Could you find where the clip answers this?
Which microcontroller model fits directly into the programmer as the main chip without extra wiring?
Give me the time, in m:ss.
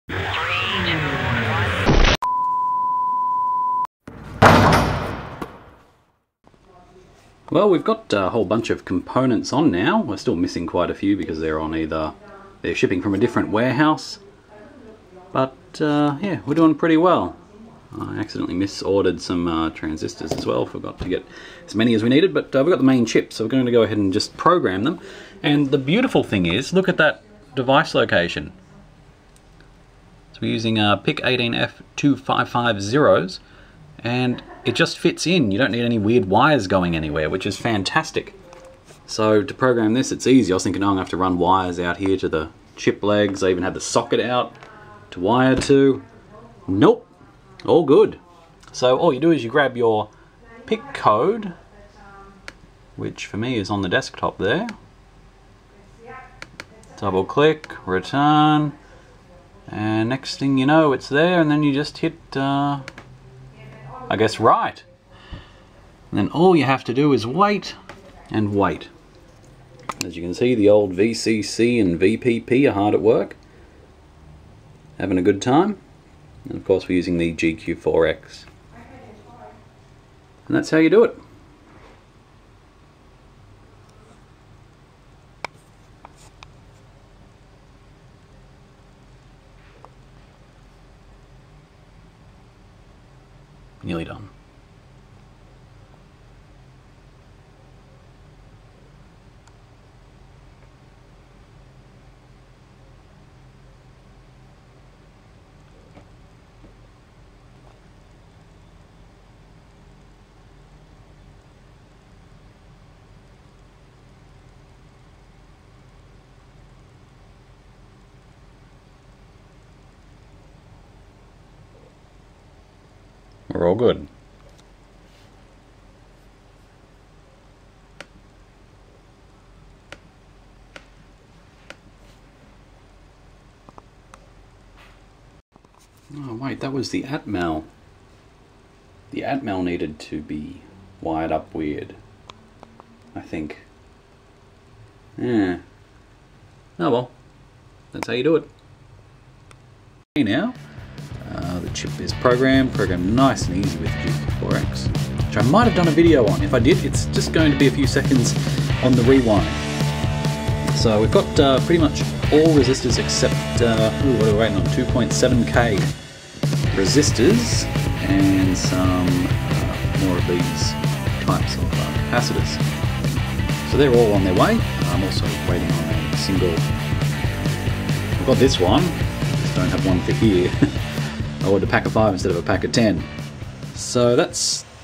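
0:31.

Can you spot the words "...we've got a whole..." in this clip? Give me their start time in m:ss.
0:07.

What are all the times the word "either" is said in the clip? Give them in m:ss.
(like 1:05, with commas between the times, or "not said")
0:11.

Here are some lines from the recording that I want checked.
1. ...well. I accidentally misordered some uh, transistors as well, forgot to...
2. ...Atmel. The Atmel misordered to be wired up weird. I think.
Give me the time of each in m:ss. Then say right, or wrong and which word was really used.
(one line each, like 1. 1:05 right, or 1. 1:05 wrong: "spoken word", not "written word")
1. 0:16 right
2. 2:17 wrong: "needed", not "misordered".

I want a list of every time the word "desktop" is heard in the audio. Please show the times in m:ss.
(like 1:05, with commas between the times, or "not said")
0:53.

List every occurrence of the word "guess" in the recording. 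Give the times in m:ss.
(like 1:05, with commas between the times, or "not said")
1:04.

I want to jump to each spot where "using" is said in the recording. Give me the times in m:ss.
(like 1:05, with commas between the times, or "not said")
0:30, 1:16.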